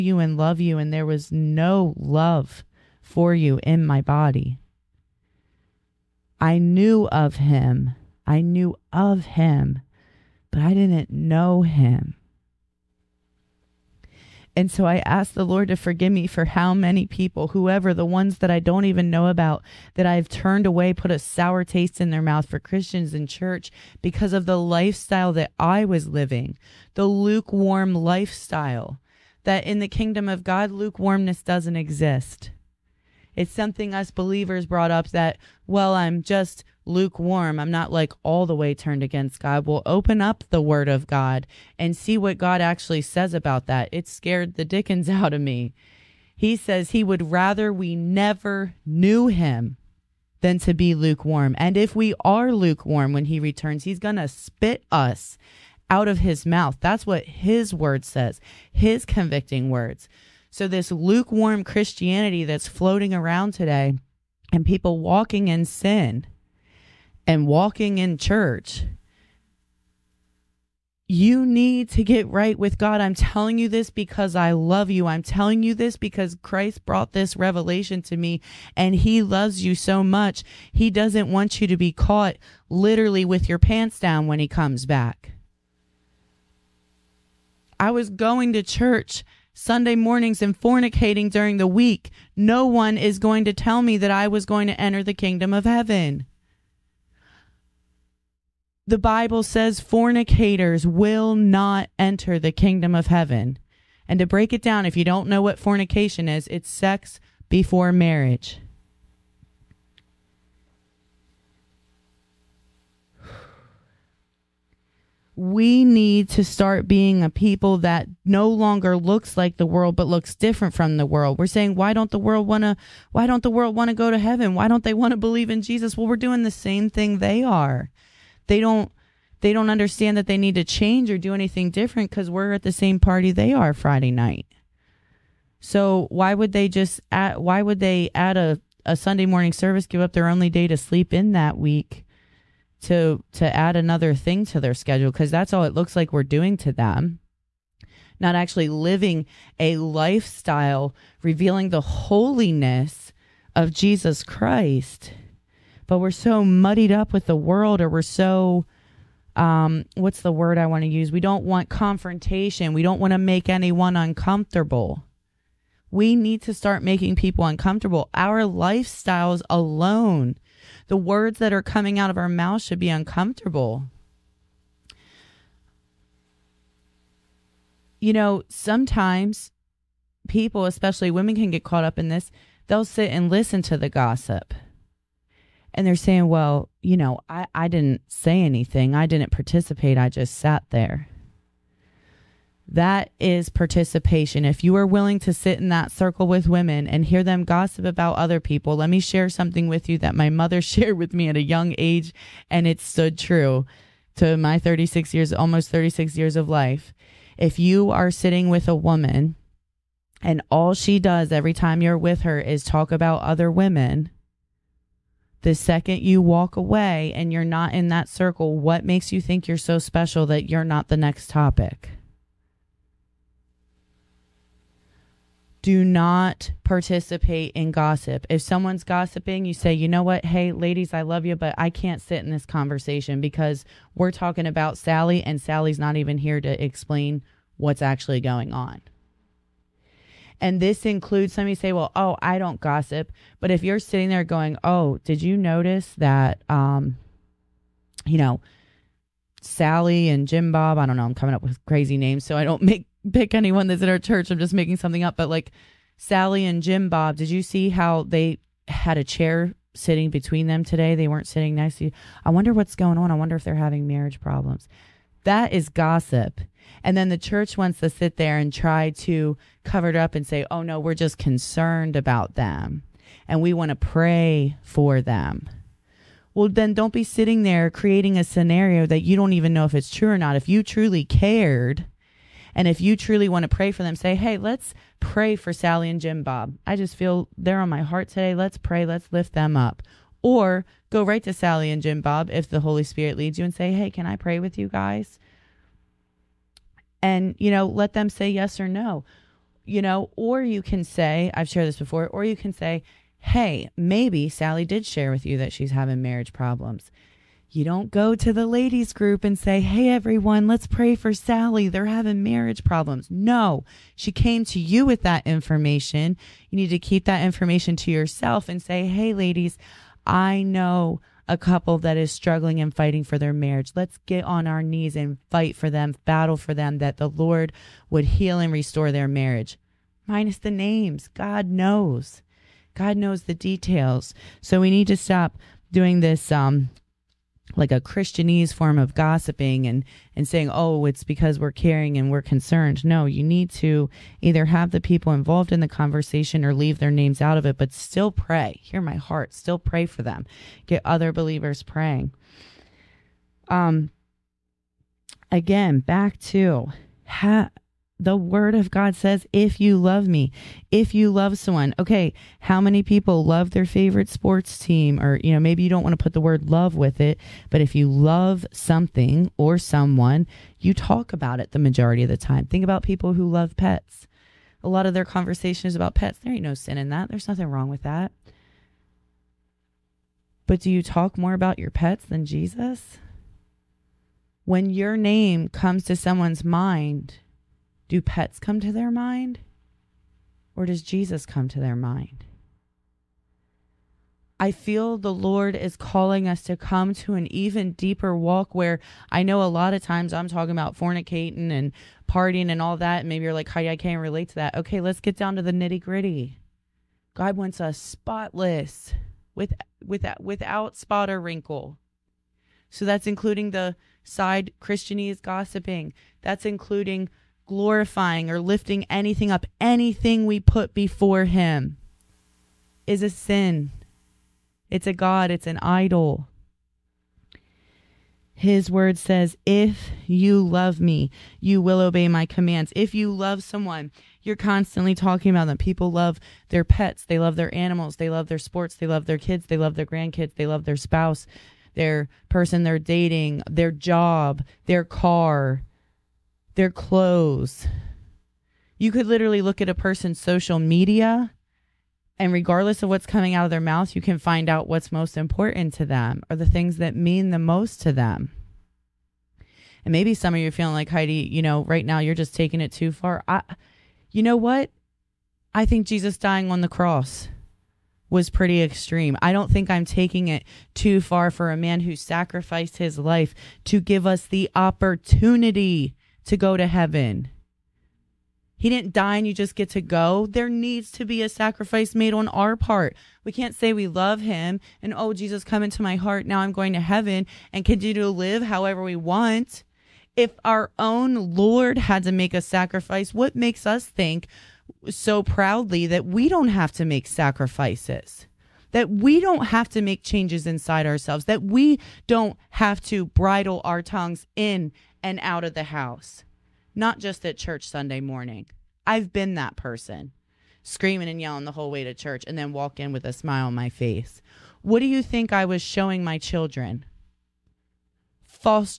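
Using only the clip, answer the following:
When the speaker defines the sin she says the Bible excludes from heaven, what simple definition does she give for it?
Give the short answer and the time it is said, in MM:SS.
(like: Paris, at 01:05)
sex before marriage, at 01:46.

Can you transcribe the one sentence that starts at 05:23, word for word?
Let's get on our knees and fight for them, battle for them, that the Lord would heal and restore their marriage.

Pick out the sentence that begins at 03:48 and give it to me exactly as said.
If someone's gossiping, you say, you know what?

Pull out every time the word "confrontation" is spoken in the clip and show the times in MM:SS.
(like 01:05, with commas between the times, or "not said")
02:41.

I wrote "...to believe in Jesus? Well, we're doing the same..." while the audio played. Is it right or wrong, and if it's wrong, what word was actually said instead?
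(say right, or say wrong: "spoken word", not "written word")
right.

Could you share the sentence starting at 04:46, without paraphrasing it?
I just feel they're on my heart today.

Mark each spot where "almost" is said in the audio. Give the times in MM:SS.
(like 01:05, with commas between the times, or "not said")
03:25.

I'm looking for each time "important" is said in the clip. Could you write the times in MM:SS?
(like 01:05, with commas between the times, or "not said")
07:35.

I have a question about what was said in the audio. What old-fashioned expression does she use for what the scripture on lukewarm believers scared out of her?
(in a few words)
the dickens.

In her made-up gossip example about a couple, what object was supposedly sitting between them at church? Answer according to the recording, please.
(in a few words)
a chair.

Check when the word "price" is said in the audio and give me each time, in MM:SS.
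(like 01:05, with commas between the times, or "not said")
not said.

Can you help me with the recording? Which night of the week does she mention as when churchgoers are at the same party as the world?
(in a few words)
Friday night.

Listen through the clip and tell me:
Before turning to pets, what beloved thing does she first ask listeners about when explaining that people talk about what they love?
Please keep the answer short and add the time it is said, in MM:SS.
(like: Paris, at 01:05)
favorite sports team, at 06:03.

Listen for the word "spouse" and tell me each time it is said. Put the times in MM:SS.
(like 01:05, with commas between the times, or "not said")
07:20.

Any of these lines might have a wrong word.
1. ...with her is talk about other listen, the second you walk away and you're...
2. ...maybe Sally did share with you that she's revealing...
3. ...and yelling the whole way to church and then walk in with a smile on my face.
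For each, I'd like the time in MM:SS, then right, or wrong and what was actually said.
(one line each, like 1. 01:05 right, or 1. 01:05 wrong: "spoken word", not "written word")
1. 03:31 wrong: "women", not "listen"
2. 05:03 wrong: "having", not "revealing"
3. 08:31 right.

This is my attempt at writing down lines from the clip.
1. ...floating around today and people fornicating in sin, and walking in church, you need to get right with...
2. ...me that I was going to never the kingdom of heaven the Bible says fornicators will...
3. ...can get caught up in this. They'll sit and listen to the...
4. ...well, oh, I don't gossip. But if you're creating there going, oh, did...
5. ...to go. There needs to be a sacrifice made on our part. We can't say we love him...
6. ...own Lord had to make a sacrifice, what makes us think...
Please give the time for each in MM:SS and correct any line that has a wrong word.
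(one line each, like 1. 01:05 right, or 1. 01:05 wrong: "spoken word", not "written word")
1. 01:02 wrong: "walking", not "fornicating"
2. 01:33 wrong: "enter", not "never"
3. 03:01 right
4. 04:01 wrong: "sitting", not "creating"
5. 07:59 right
6. 08:10 right.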